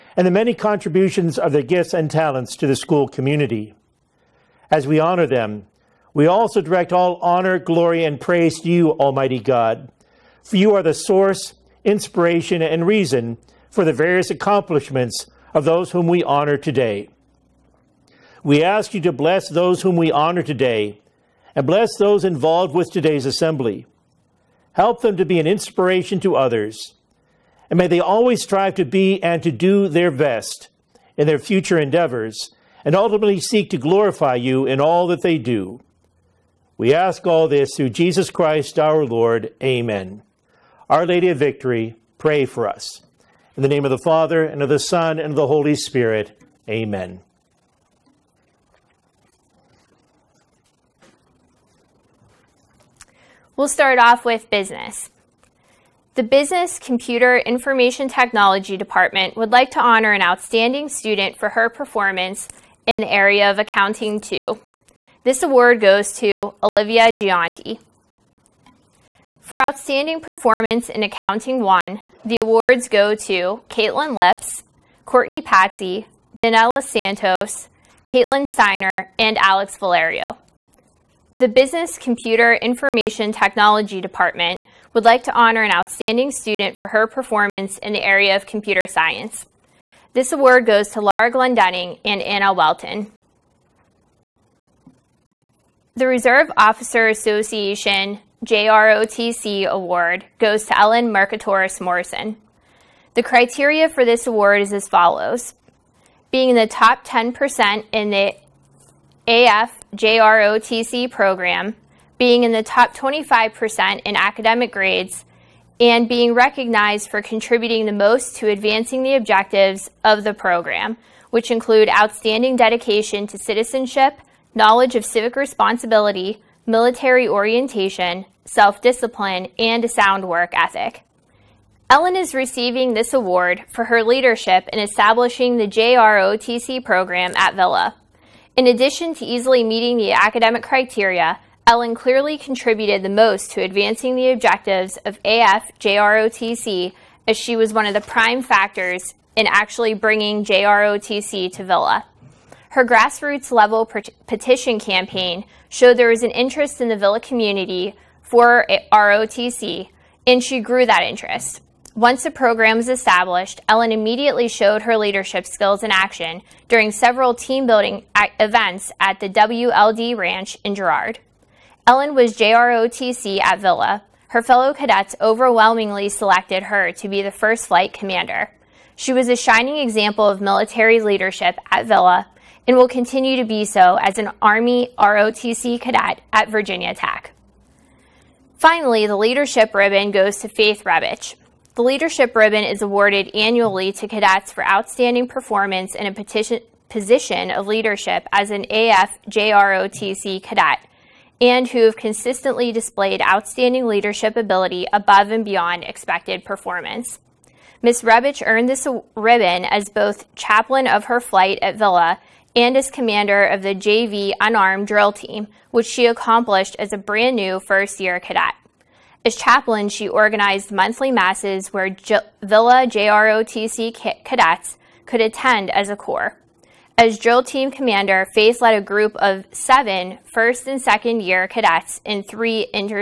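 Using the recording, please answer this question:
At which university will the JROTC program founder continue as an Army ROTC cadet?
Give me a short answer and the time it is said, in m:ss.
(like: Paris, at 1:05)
Virginia Tech, at 3:06.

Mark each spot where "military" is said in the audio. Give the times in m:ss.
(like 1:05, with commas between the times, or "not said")
2:06, 3:00.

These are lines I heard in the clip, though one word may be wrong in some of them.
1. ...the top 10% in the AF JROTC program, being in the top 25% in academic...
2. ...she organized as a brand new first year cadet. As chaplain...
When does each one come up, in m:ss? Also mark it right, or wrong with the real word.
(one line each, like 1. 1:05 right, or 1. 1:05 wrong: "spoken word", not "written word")
1. 1:46 right
2. 3:35 wrong: "accomplished", not "organized".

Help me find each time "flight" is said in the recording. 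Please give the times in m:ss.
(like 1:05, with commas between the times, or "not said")
2:57, 3:31.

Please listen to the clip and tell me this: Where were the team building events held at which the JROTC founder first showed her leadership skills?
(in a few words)
WLD Ranch.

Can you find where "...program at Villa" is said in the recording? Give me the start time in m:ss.
2:16.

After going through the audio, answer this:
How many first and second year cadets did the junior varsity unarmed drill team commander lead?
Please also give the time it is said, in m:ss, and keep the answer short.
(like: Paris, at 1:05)
7, at 3:49.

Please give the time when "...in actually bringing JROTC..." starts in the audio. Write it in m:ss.
2:29.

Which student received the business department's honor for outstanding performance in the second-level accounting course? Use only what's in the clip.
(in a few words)
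Olivia Gianti.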